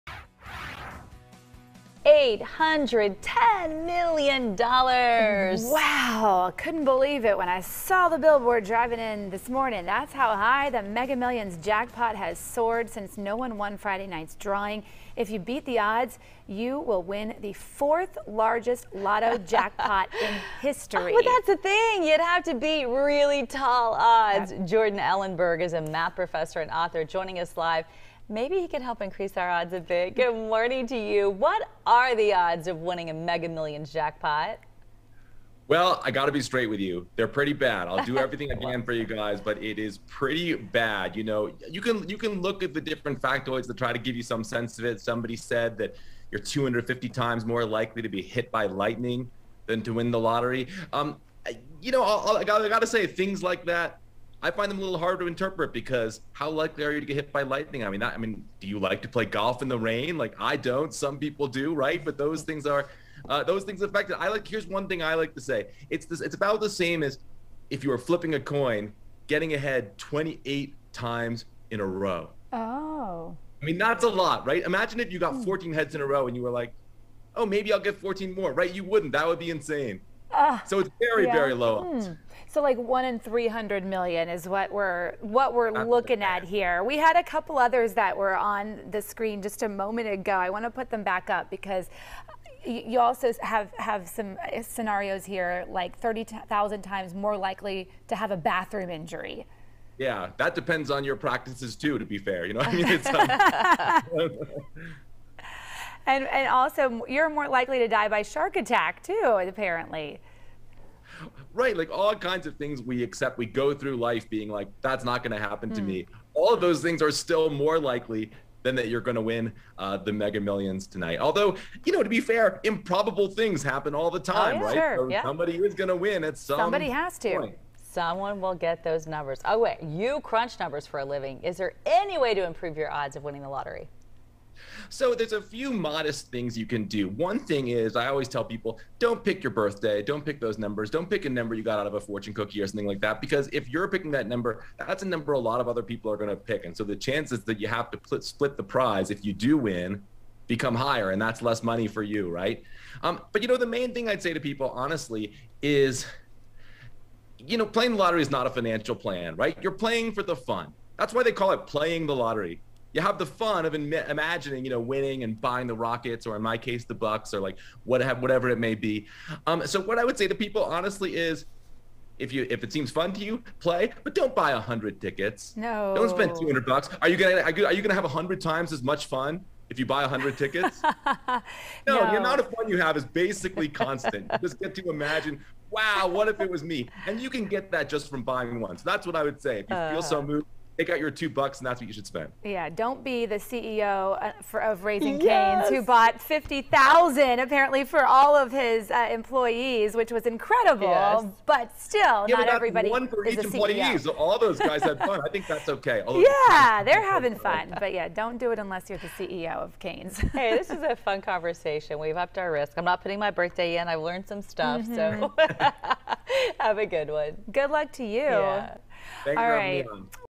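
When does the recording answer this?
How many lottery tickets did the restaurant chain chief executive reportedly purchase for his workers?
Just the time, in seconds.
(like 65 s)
196 s.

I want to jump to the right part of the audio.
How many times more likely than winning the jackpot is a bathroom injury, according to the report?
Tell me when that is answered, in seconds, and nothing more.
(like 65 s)
95 s.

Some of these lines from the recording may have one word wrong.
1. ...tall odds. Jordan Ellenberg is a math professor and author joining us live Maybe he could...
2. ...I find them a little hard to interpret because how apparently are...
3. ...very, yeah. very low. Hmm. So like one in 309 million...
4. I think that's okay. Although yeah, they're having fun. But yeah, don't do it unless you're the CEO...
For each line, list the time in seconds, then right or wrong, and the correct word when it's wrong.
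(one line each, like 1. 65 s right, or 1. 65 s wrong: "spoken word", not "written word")
1. 23 s right
2. 54 s wrong: "likely", not "apparently"
3. 80 s wrong: "300", not "309"
4. 205 s right.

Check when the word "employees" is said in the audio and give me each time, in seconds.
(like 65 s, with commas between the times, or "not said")
199 s, 203 s.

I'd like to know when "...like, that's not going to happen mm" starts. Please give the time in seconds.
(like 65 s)
114 s.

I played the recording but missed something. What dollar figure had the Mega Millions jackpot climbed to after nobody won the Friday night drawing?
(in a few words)
$810 million.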